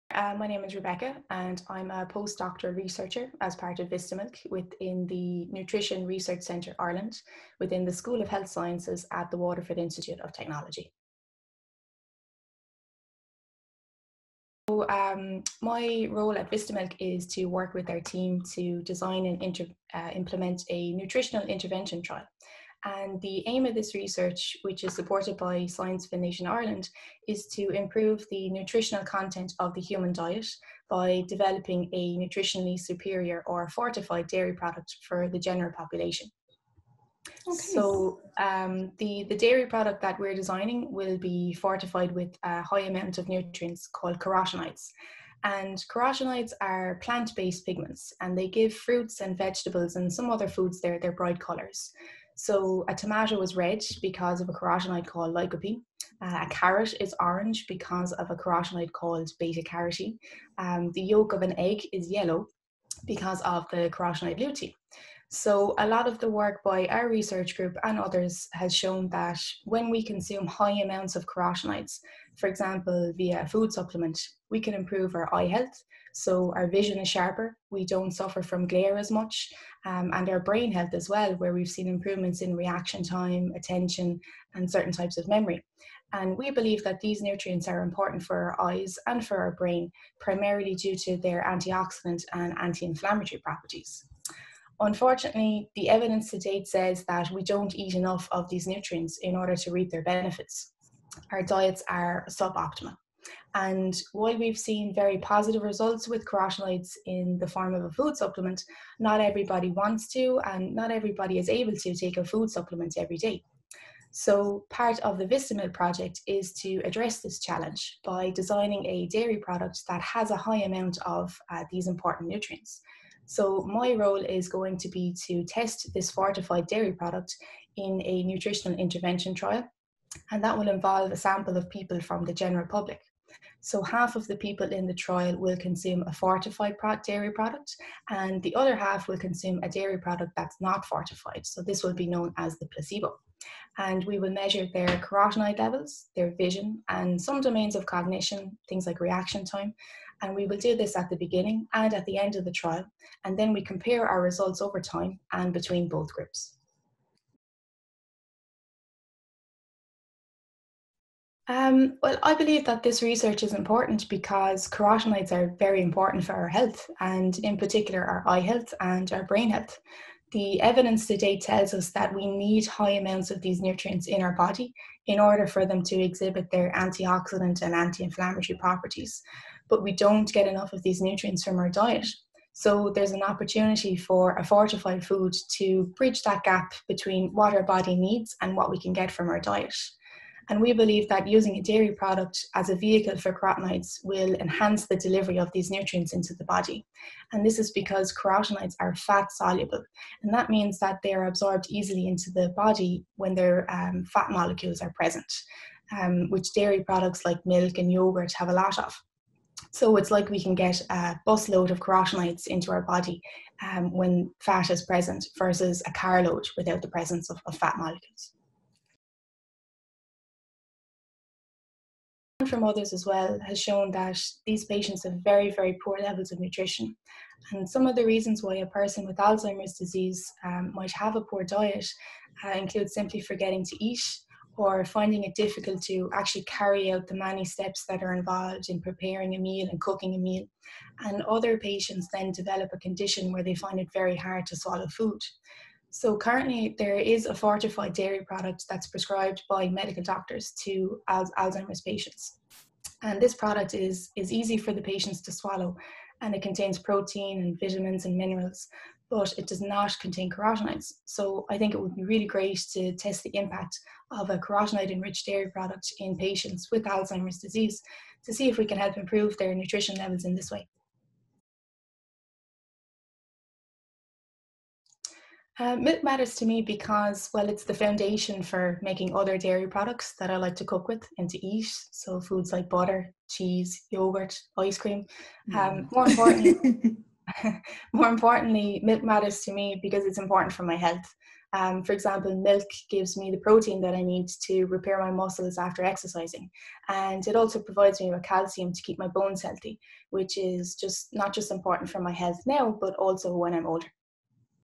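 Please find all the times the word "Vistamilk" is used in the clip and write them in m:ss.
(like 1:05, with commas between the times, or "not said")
0:03, 0:16, 1:55.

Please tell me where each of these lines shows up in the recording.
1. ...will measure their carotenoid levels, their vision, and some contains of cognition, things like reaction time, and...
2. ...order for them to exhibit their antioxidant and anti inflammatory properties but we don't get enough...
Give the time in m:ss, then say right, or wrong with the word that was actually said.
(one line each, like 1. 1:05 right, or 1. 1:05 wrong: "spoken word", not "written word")
1. 2:24 wrong: "domains", not "contains"
2. 2:55 right.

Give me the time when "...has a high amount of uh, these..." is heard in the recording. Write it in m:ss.
2:00.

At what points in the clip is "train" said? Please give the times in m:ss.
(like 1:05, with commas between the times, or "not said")
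not said.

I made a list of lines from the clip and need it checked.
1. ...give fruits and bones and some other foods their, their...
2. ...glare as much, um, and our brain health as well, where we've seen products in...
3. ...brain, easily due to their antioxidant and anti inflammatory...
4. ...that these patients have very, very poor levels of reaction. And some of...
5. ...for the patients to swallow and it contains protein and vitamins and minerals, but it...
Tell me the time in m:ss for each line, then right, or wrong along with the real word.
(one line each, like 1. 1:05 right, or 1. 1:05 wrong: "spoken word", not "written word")
1. 0:48 wrong: "vegetables", not "bones"
2. 1:18 wrong: "improvements", not "products"
3. 1:29 wrong: "primarily", not "easily"
4. 3:43 wrong: "nutrition", not "reaction"
5. 4:14 right.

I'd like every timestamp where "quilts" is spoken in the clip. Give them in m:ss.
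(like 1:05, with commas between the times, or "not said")
not said.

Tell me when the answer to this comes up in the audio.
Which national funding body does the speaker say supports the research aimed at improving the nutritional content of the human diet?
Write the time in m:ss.
0:25.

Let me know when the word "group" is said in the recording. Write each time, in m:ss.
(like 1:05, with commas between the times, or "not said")
1:07, 2:36.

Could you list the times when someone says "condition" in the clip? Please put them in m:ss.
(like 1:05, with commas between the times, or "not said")
4:02.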